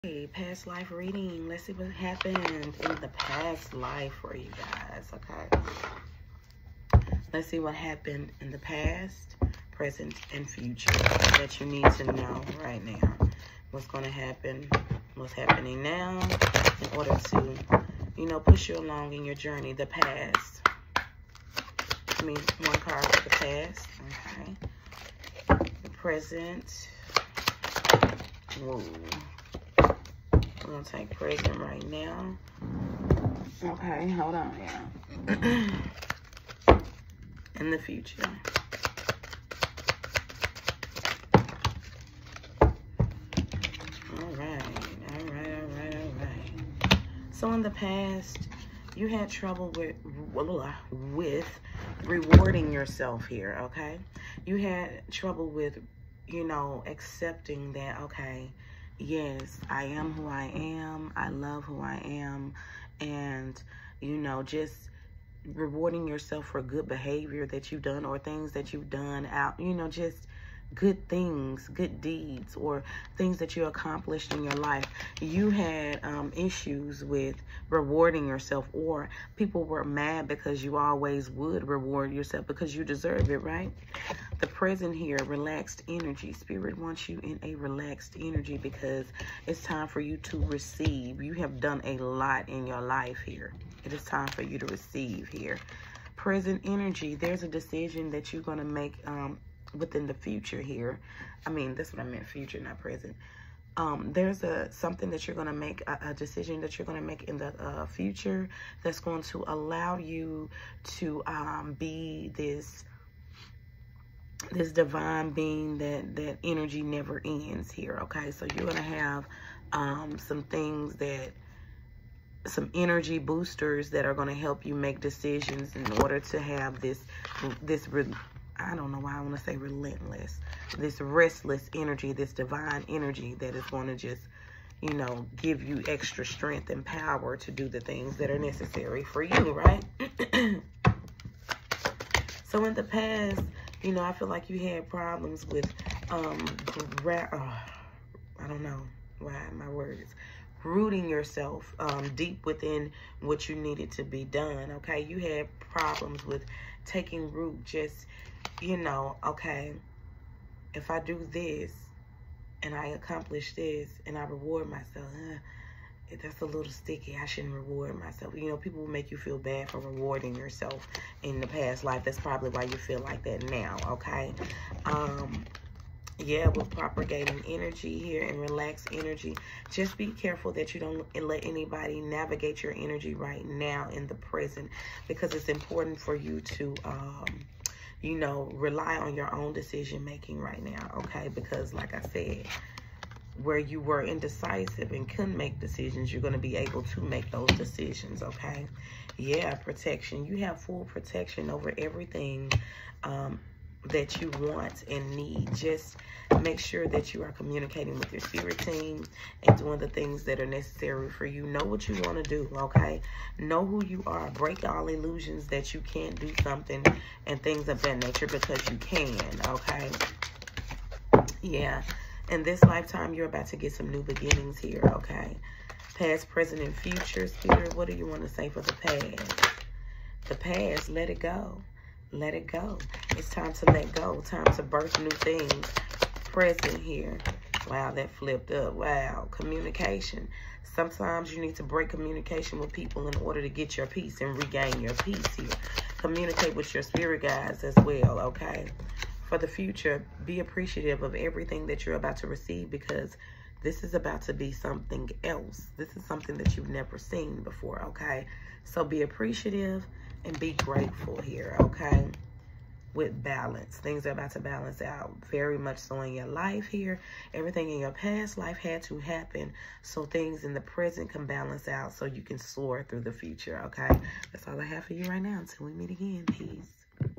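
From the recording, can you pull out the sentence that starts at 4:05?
Communicate with your spirit guides as well, okay?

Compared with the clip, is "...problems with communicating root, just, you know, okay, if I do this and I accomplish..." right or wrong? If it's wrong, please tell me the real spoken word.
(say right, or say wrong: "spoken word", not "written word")
wrong: "taking", not "communicating".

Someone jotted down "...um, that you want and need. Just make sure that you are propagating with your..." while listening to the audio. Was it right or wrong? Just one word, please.
wrong.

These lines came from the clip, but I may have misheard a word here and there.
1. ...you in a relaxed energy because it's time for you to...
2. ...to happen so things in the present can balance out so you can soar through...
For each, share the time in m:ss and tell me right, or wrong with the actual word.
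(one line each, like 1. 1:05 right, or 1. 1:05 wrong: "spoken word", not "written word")
1. 1:27 right
2. 4:28 right.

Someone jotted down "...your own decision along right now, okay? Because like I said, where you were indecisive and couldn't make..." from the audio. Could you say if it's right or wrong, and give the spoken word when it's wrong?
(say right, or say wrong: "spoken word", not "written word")
wrong: "making", not "along".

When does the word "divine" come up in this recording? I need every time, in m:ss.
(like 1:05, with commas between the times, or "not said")
1:54, 2:12.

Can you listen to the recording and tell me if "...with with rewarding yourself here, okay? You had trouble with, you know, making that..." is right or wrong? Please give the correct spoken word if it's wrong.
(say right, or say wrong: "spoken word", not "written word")
wrong: "accepting", not "making".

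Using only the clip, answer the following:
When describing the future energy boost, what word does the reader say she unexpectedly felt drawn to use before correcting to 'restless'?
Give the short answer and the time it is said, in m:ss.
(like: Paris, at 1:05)
Relentless, at 2:09.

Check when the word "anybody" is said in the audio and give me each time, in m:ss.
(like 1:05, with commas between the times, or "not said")
3:01.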